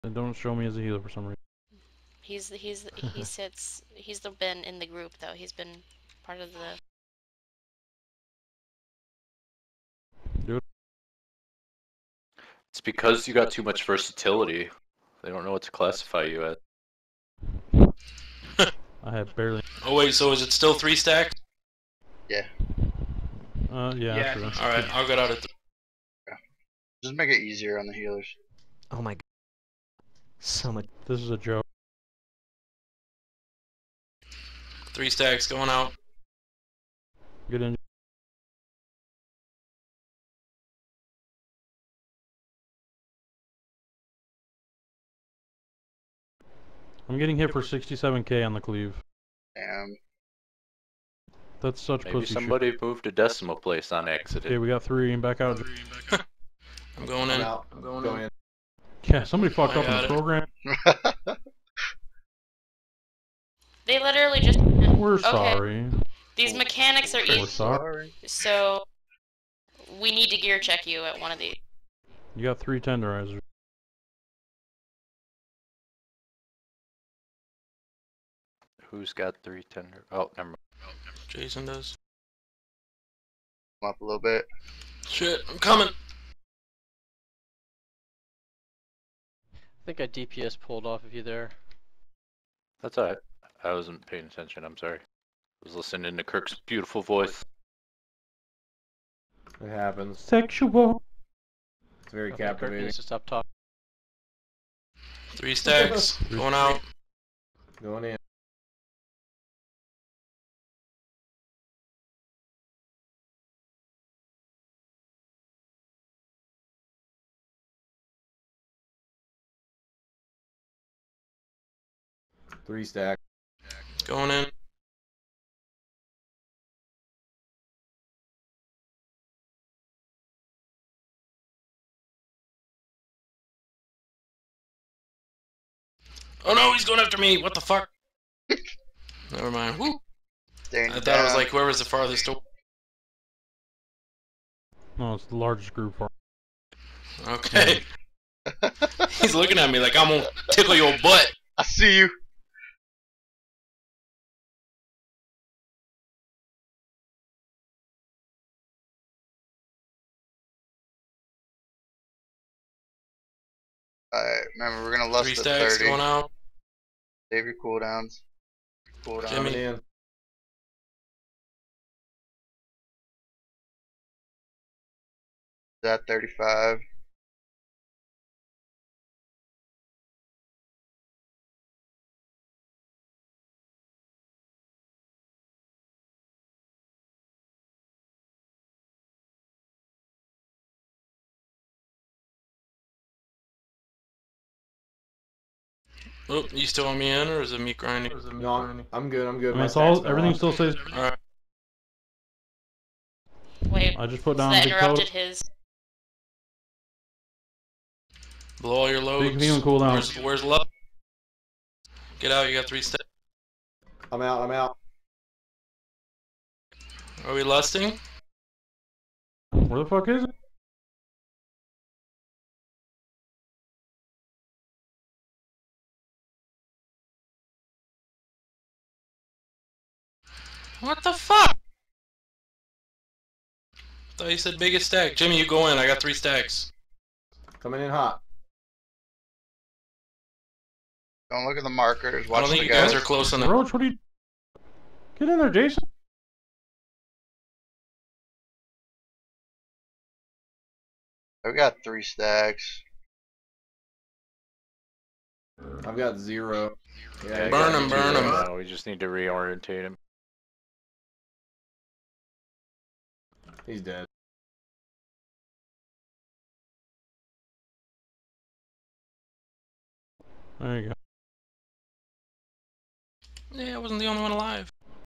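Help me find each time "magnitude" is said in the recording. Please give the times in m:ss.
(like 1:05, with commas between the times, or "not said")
not said.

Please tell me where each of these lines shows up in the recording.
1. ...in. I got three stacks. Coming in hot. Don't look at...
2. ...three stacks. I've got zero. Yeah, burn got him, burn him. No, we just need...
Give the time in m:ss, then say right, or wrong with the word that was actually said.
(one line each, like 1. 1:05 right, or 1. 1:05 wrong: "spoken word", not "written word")
1. 3:55 right
2. 4:11 right.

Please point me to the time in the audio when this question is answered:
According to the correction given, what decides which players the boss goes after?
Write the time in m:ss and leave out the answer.
2:25.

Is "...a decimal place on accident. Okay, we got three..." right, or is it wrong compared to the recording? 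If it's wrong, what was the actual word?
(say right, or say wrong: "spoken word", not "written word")
right.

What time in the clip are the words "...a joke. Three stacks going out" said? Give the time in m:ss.
0:31.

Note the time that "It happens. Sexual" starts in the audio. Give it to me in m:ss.
1:39.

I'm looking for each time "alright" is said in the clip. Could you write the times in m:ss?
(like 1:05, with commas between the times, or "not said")
1:32, 2:44.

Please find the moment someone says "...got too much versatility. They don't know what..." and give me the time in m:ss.
0:13.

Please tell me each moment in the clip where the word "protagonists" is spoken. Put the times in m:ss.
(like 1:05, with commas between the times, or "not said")
not said.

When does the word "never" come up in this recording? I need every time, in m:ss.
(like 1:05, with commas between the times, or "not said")
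1:20, 2:19.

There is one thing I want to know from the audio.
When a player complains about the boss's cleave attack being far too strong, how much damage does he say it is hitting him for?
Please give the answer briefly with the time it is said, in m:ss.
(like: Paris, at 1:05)
67k, at 0:47.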